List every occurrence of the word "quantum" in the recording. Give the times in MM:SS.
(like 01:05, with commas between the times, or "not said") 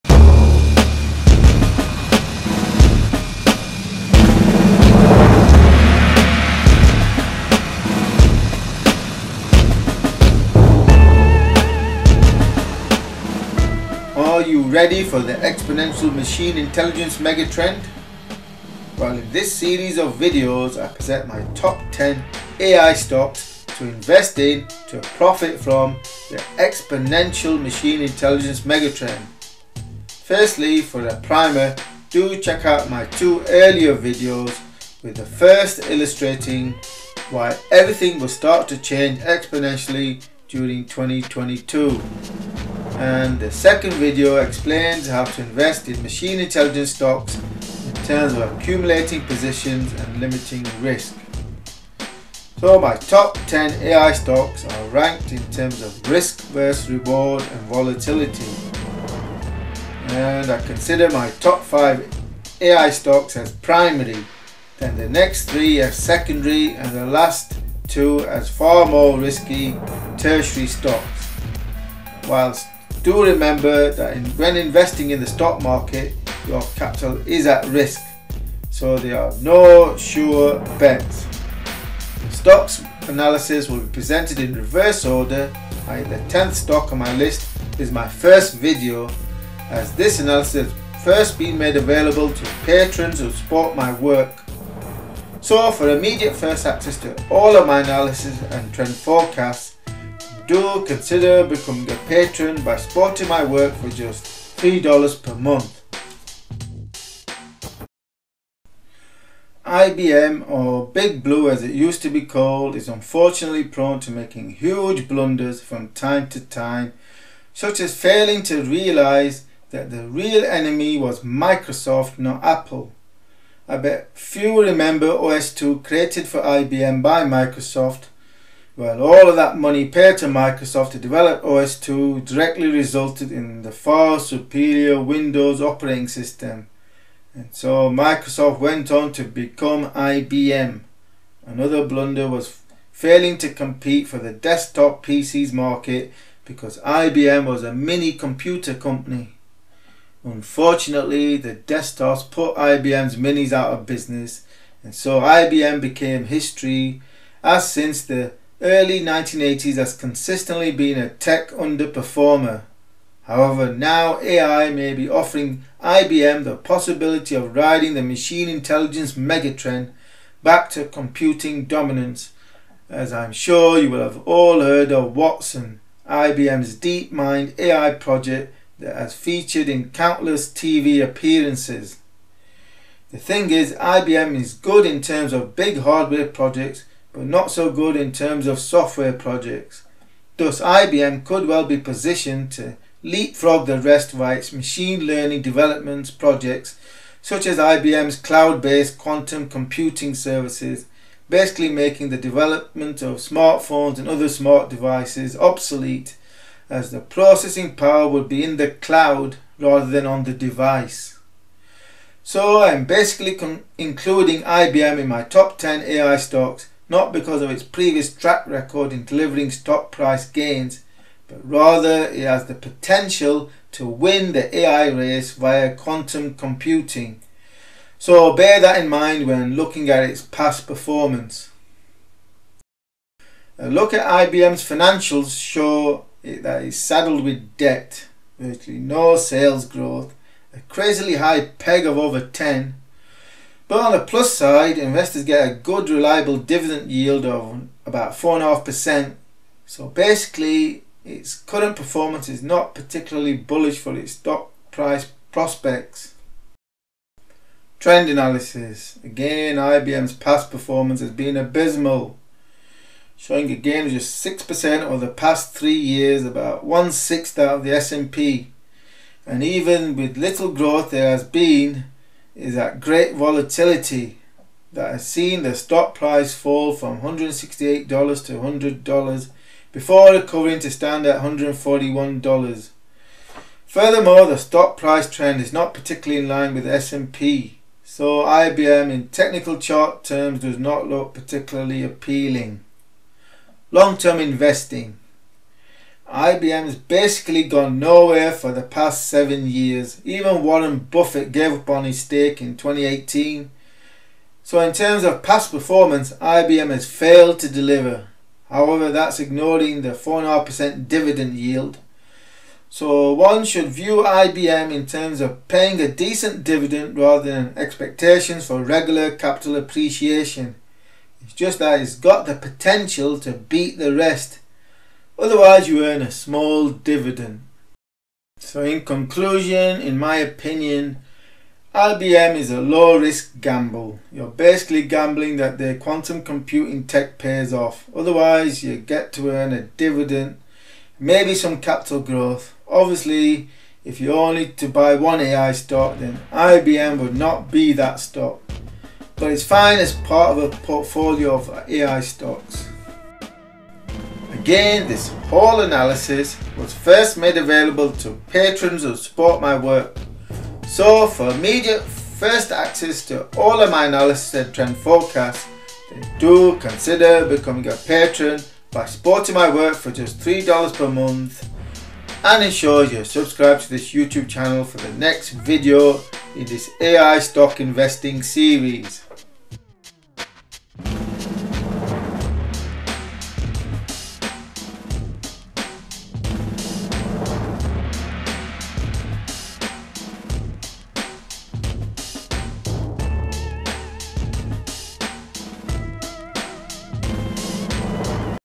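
03:18, 03:45, 05:35.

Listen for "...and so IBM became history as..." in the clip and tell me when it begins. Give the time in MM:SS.
02:34.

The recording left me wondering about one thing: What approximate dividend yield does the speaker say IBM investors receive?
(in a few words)
4.5%.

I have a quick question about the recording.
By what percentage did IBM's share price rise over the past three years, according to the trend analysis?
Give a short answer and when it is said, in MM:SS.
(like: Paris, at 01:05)
6%, at 04:24.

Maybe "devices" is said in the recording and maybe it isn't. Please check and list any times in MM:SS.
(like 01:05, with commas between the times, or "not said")
03:24, 03:30.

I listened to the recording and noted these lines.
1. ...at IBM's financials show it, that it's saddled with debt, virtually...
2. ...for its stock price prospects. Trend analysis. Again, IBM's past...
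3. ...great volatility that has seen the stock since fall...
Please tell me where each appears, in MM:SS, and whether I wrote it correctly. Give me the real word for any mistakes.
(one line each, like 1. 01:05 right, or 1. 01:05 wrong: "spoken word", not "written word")
1. 03:53 right
2. 04:13 right
3. 04:32 wrong: "price", not "since".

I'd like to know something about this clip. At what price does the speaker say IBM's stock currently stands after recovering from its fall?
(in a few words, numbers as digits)
$141.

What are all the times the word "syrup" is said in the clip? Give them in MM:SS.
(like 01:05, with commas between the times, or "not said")
not said.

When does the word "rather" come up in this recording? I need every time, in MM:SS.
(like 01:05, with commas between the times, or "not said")
03:29, 03:41, 05:16.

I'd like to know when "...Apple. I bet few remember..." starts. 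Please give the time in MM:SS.
02:02.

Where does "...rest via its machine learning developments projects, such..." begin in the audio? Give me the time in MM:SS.
03:13.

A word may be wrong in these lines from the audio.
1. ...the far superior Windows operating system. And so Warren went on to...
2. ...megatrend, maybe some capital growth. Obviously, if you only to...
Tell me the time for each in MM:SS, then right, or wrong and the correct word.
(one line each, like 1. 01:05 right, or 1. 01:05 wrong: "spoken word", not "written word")
1. 02:13 wrong: "Microsoft", not "Warren"
2. 05:39 wrong: "dividend", not "megatrend".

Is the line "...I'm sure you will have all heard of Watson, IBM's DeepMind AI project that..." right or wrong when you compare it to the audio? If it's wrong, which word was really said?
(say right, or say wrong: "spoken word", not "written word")
right.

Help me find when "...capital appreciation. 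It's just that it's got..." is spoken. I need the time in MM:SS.
05:19.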